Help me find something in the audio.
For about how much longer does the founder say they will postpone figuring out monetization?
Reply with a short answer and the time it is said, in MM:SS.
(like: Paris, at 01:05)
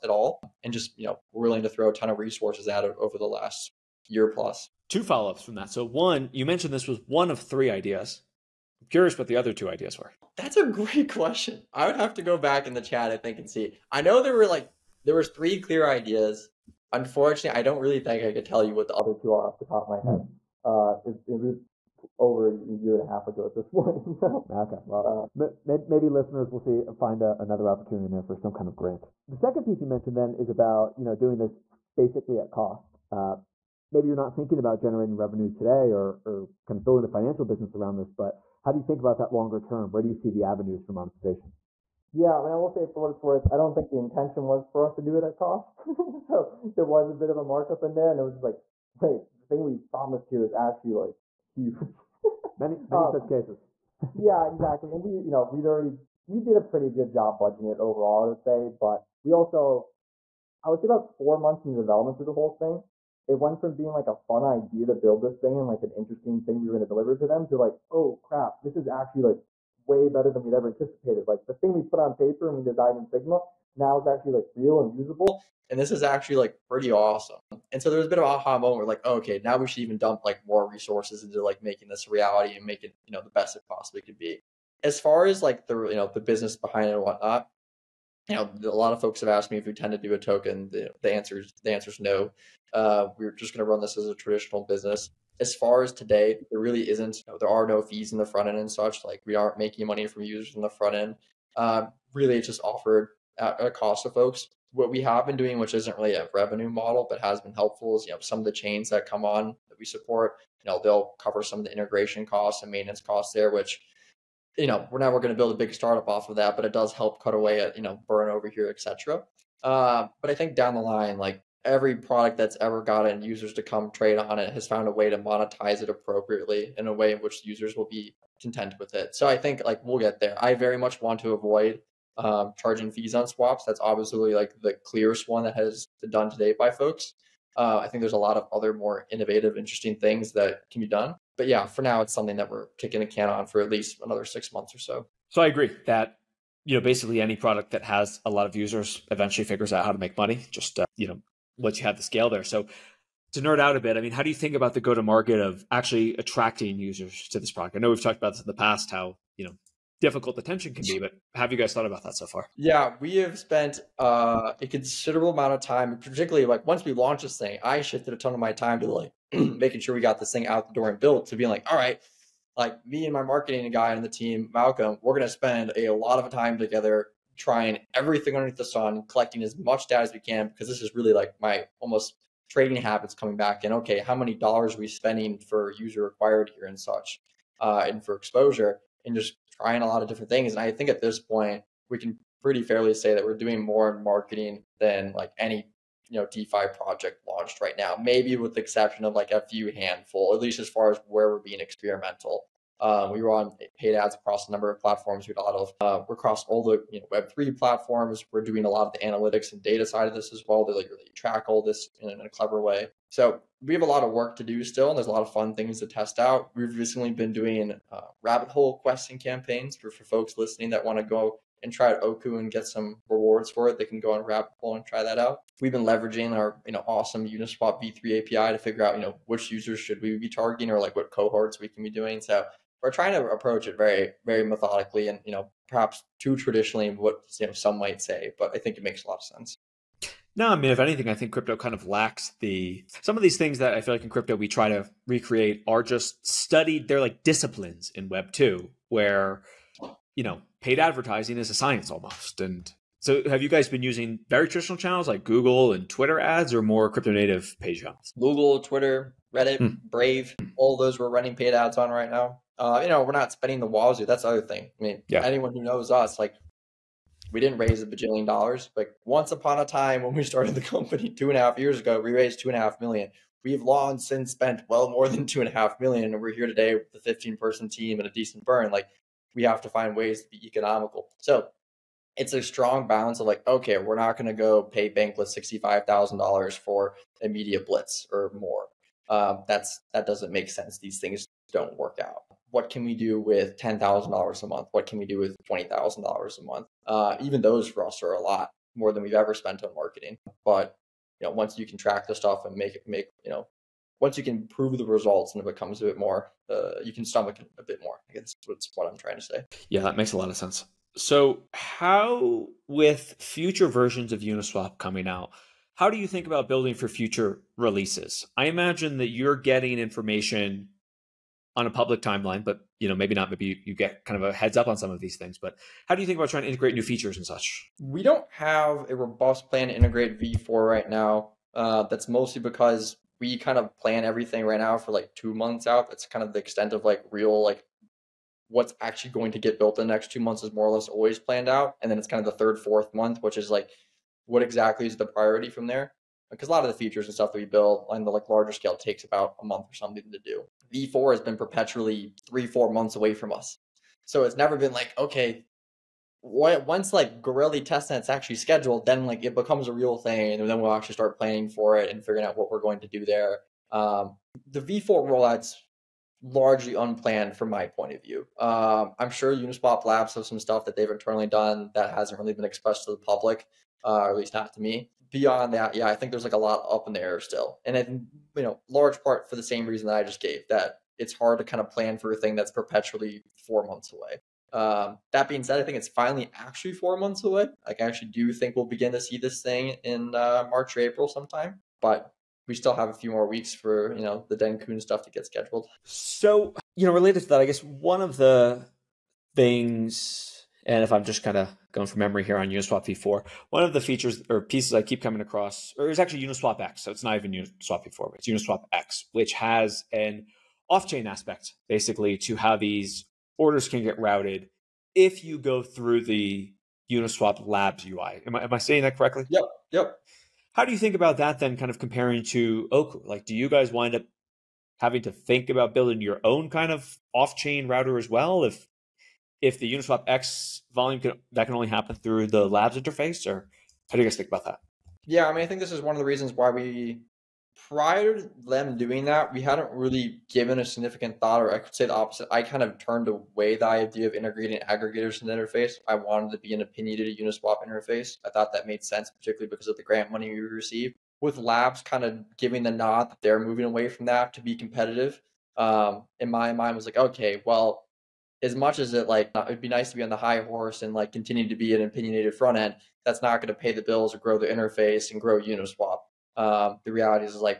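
6 months, at 02:24.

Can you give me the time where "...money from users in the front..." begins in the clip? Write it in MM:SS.
01:39.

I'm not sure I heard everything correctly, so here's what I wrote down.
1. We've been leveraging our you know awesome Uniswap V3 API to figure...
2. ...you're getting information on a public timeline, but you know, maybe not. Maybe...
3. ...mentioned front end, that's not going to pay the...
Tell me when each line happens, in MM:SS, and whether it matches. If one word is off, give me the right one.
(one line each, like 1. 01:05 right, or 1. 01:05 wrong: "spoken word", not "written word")
1. 03:45 right
2. 05:19 right
3. 07:41 wrong: "opinionated", not "mentioned".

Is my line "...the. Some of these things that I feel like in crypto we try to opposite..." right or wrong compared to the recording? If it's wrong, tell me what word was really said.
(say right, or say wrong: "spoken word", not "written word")
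wrong: "recreate", not "opposite".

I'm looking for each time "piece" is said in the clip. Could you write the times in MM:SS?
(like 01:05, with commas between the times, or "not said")
00:29, 06:44.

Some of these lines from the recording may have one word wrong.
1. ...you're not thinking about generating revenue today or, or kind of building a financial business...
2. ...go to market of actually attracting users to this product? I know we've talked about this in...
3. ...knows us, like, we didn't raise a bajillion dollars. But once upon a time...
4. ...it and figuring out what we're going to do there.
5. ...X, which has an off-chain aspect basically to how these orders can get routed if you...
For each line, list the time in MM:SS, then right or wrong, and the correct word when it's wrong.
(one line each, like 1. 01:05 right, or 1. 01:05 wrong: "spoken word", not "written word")
1. 00:34 right
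2. 02:34 right
3. 04:25 right
4. 06:01 right
5. 06:48 right.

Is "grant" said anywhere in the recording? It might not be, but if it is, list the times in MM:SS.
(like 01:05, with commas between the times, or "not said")
00:28, 07:29.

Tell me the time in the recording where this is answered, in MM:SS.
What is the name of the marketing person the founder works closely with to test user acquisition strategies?
02:54.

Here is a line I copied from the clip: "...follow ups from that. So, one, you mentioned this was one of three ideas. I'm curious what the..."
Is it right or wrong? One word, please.
right.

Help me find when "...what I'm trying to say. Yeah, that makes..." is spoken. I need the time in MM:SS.
05:08.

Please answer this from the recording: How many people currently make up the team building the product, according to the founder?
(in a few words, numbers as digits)
15.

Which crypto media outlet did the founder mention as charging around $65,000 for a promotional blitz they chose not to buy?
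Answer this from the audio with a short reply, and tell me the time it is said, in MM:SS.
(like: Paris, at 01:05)
Bankless, at 04:44.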